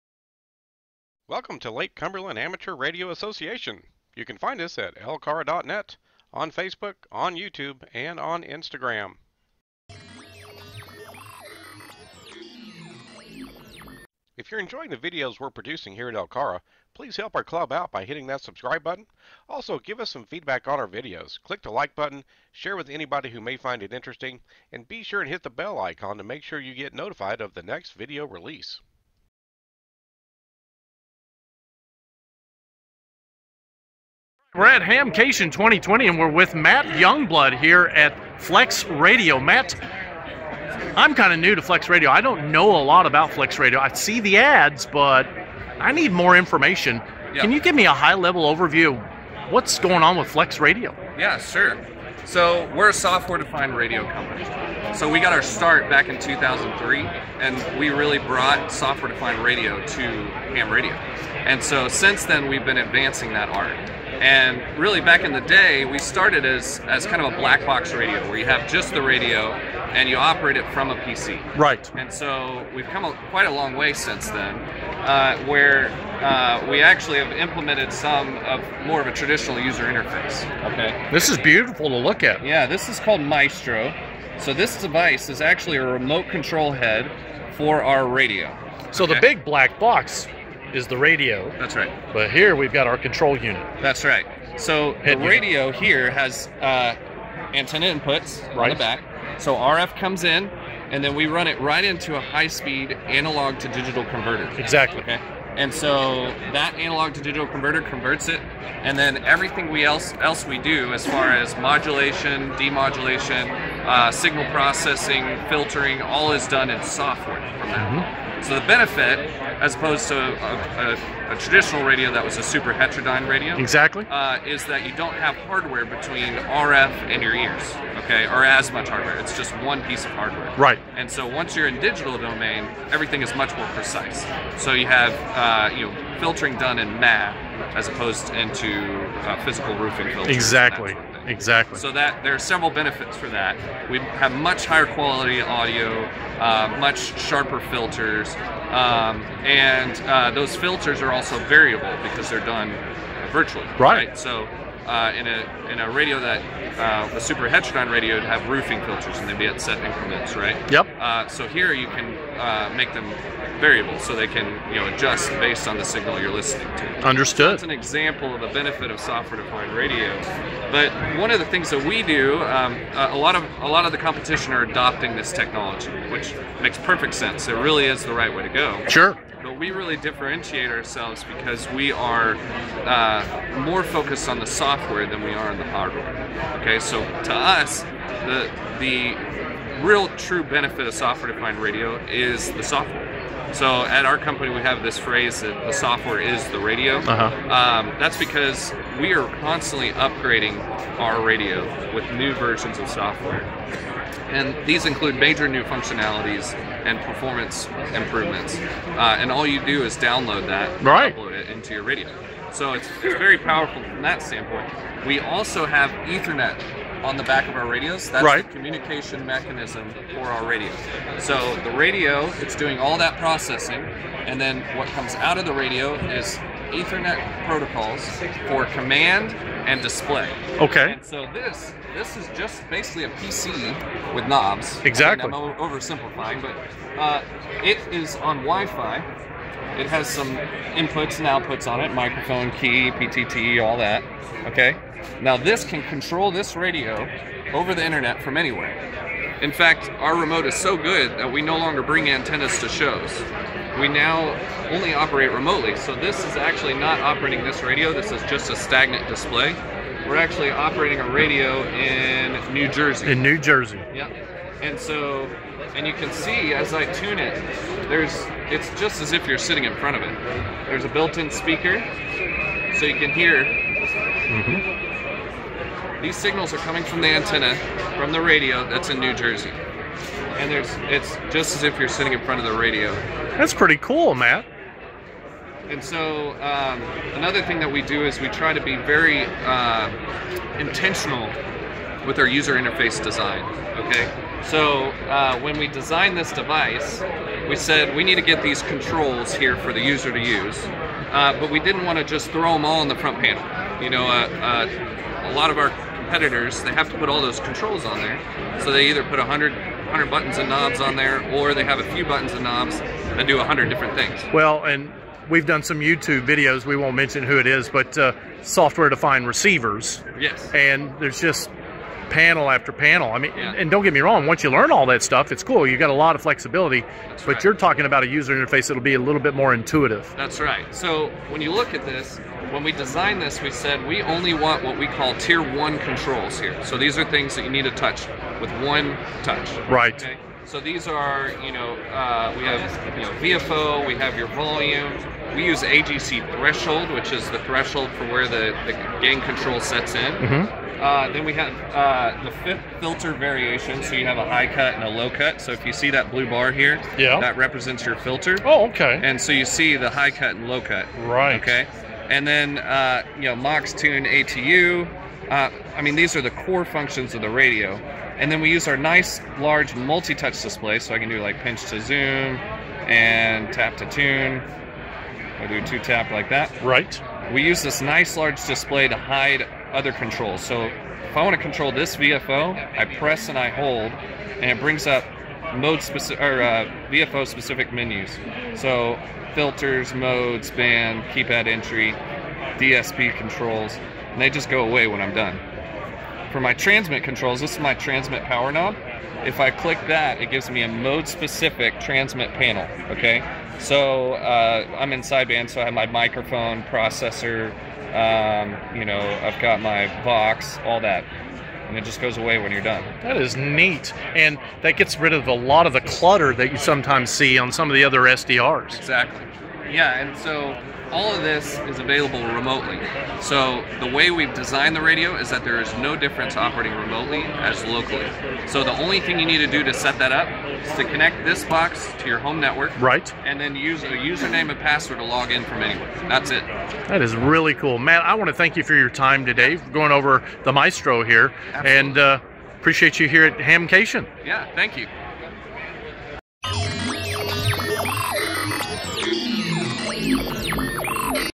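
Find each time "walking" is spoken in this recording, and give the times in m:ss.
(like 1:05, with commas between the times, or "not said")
not said.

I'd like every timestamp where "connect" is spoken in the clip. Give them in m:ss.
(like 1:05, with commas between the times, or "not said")
7:10.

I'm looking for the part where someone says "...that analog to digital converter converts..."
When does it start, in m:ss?
1:46.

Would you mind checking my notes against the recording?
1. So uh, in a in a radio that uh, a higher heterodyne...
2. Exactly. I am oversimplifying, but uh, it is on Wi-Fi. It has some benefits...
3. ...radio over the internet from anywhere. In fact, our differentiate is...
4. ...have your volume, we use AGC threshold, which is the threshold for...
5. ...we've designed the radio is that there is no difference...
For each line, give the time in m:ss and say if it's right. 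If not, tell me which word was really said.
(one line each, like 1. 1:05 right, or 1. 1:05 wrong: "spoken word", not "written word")
1. 2:34 wrong: "super", not "higher"
2. 3:54 wrong: "inputs", not "benefits"
3. 4:06 wrong: "remote", not "differentiate"
4. 5:43 right
5. 7:04 right.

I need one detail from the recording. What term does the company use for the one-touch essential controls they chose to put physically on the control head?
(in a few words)
Tier one controls.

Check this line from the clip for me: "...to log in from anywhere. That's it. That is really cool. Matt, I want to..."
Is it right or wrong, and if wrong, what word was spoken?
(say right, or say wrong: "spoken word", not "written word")
right.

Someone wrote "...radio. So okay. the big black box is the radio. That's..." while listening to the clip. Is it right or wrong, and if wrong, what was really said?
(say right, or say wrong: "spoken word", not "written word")
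right.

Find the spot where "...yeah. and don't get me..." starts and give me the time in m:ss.
5:23.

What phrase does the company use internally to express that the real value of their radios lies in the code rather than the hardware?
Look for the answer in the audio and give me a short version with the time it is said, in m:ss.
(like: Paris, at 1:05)
The software is the radio, at 3:15.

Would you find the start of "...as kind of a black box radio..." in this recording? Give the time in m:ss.
1:06.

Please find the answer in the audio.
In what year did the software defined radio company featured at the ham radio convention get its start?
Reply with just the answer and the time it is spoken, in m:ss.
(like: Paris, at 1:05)
2003, at 0:56.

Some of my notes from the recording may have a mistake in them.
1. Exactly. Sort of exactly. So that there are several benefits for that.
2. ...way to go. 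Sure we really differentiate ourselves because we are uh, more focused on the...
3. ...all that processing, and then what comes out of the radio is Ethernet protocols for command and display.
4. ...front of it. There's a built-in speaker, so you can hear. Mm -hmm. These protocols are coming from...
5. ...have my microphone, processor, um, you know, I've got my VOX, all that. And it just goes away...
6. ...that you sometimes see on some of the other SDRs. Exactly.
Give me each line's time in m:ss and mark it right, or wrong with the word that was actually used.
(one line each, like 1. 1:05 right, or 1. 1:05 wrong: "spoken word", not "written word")
1. 2:20 right
2. 2:58 right
3. 3:42 right
4. 4:29 wrong: "signals", not "protocols"
5. 6:45 right
6. 6:56 right.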